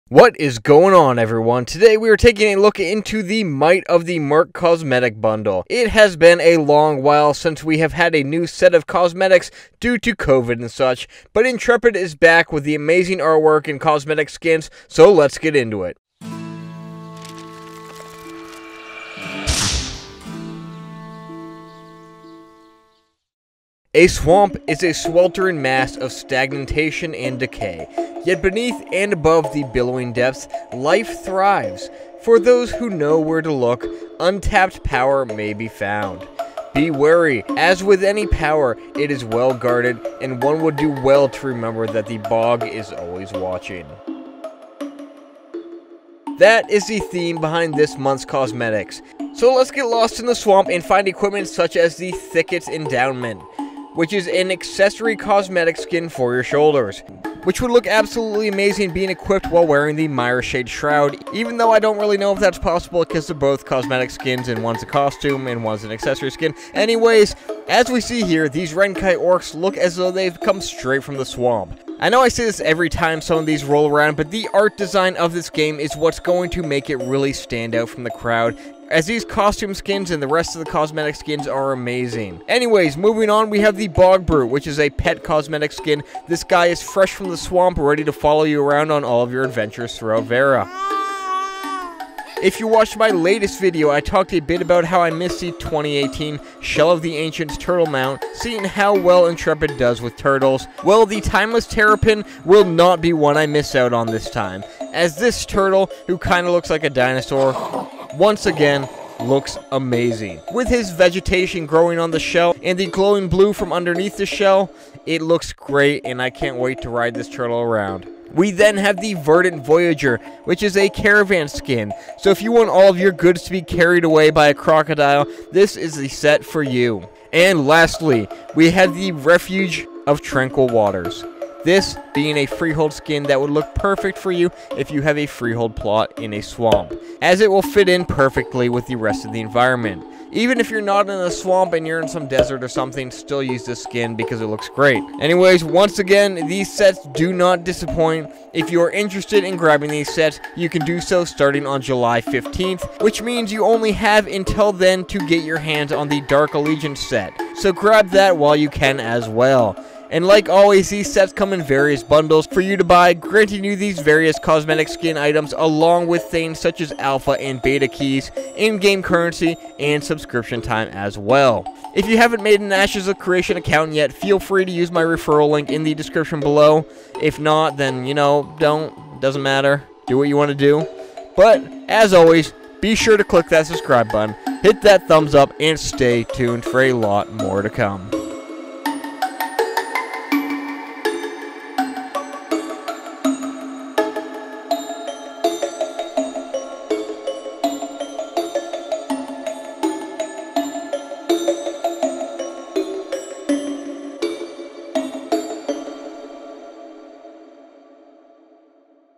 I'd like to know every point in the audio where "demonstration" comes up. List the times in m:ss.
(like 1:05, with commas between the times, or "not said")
not said.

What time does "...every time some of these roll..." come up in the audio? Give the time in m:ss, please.
1:12.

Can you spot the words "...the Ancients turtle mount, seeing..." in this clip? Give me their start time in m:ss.
1:37.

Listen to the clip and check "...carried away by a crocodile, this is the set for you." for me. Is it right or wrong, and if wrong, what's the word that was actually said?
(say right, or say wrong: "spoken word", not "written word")
right.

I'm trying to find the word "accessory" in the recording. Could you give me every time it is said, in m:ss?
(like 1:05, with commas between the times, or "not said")
0:54, 1:05.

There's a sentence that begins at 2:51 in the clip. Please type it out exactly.
If you haven't made an Ashes of Creation account yet, feel free to use my referral link in the description below.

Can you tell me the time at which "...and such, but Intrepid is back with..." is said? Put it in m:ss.
0:10.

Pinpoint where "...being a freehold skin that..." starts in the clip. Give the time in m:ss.
2:12.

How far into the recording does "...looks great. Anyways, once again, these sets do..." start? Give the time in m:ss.
2:24.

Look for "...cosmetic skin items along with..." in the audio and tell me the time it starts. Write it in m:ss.
2:44.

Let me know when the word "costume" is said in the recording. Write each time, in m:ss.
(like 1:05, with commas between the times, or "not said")
1:04, 1:19.